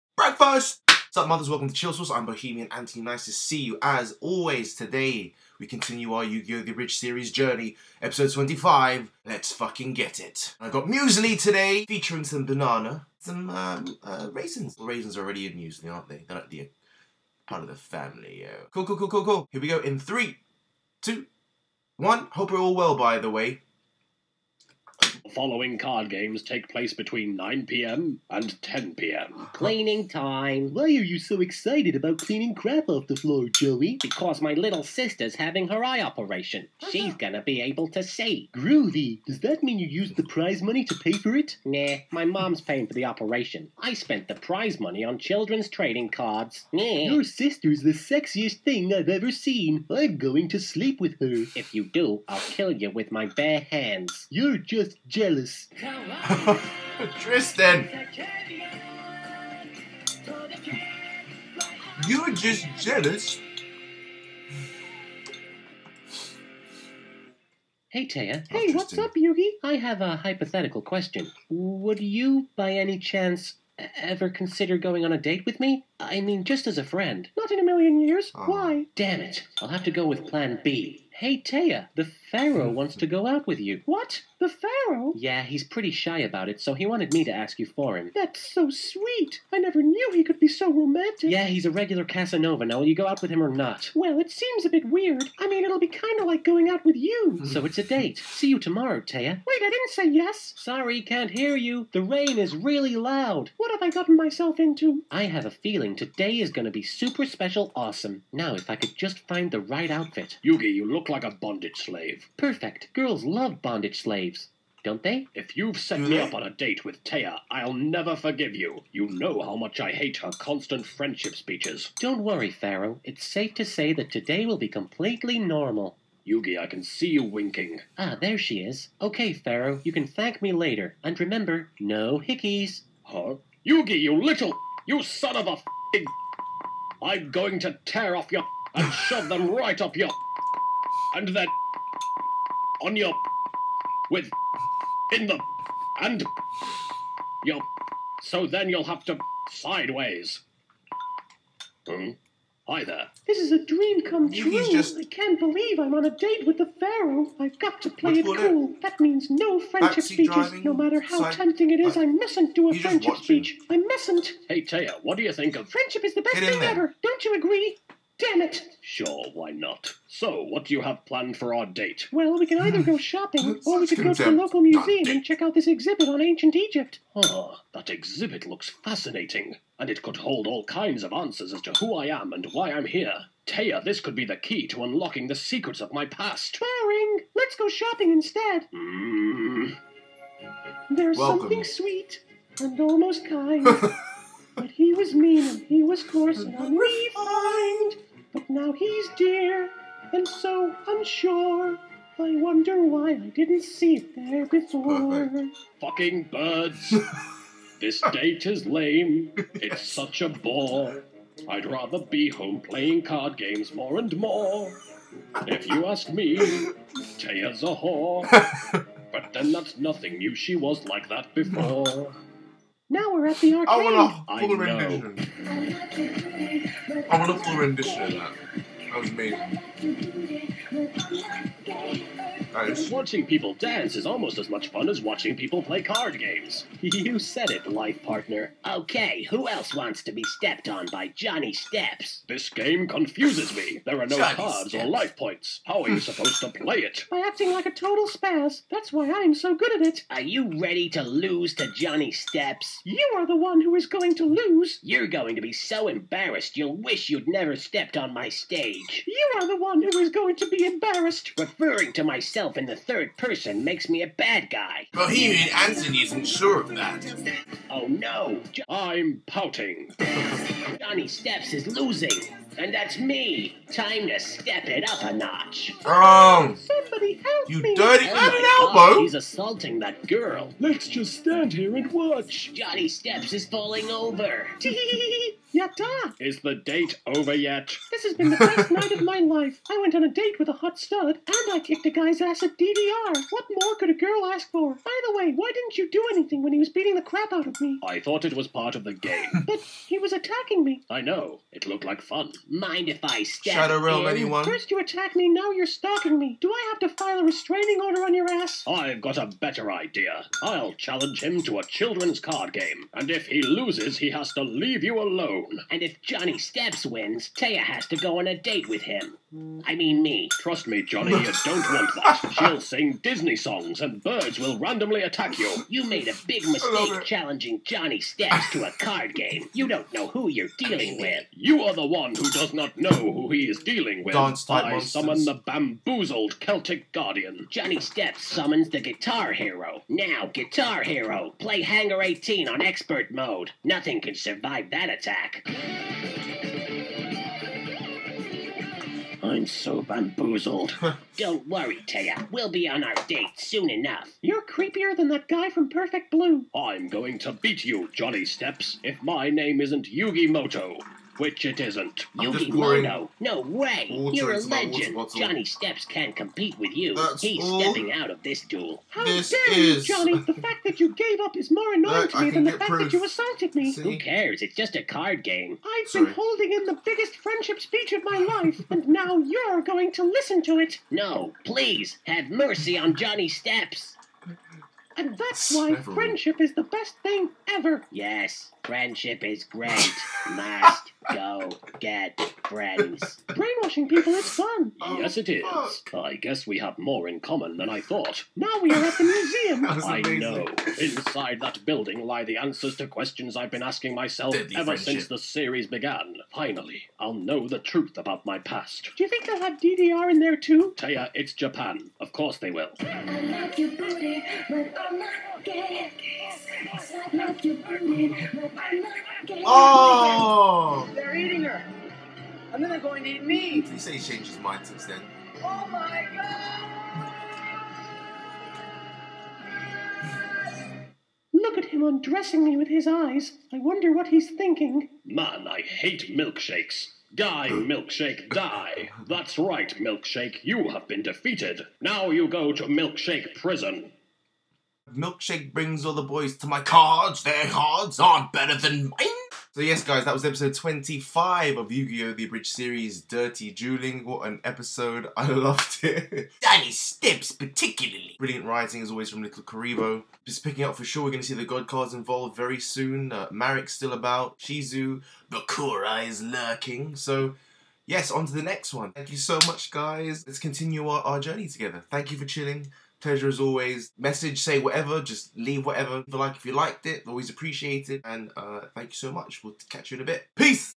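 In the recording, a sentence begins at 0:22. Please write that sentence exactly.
Hope we're all well, by the way following card games take place between 9 p.m.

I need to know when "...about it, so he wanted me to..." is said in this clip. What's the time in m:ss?
1:26.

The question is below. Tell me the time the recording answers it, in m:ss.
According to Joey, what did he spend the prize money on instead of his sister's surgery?
0:45.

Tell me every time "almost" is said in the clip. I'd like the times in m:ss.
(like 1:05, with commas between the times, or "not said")
3:12, 3:54.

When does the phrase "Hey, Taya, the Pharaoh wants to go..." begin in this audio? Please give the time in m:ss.
1:21.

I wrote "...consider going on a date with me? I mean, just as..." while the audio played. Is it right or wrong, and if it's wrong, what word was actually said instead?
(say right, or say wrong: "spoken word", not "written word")
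right.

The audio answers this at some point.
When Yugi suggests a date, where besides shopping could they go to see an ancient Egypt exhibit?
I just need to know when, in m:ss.
2:54.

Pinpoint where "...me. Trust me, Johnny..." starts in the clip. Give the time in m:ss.
5:20.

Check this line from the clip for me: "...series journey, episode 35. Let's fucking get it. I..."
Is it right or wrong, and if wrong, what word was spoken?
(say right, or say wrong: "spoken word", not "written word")
wrong: "25", not "35".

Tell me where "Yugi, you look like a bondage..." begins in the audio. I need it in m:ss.
1:50.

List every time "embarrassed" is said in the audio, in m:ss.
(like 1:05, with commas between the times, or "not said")
4:15, 4:20.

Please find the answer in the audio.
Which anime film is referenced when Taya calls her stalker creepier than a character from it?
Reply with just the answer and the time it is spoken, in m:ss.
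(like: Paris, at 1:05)
Perfect Blue, at 5:55.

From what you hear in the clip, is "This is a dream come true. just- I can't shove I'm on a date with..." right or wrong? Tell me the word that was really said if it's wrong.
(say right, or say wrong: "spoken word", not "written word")
wrong: "believe", not "shove".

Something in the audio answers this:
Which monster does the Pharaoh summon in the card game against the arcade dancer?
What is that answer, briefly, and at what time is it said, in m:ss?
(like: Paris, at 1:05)
Celtic Guardian, at 5:36.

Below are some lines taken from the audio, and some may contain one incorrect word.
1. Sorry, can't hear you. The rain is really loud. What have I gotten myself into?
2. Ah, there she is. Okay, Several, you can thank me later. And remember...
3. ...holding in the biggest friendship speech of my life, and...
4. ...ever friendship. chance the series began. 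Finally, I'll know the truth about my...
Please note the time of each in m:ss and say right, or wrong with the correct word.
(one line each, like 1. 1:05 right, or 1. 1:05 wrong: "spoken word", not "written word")
1. 1:40 right
2. 2:07 wrong: "Pharaoh", not "Several"
3. 6:16 right
4. 6:44 wrong: "since", not "chance".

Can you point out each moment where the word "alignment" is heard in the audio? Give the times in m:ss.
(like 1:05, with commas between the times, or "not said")
not said.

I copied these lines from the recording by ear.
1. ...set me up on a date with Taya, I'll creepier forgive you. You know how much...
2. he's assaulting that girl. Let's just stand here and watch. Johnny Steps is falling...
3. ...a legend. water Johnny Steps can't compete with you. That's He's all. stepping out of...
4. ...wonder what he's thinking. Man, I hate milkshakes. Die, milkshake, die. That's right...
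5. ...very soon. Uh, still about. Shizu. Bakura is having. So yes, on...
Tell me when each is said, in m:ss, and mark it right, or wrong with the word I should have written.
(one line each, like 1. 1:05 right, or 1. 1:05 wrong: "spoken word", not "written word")
1. 1:55 wrong: "never", not "creepier"
2. 4:39 right
3. 6:04 right
4. 7:13 right
5. 7:42 wrong: "lurking", not "having".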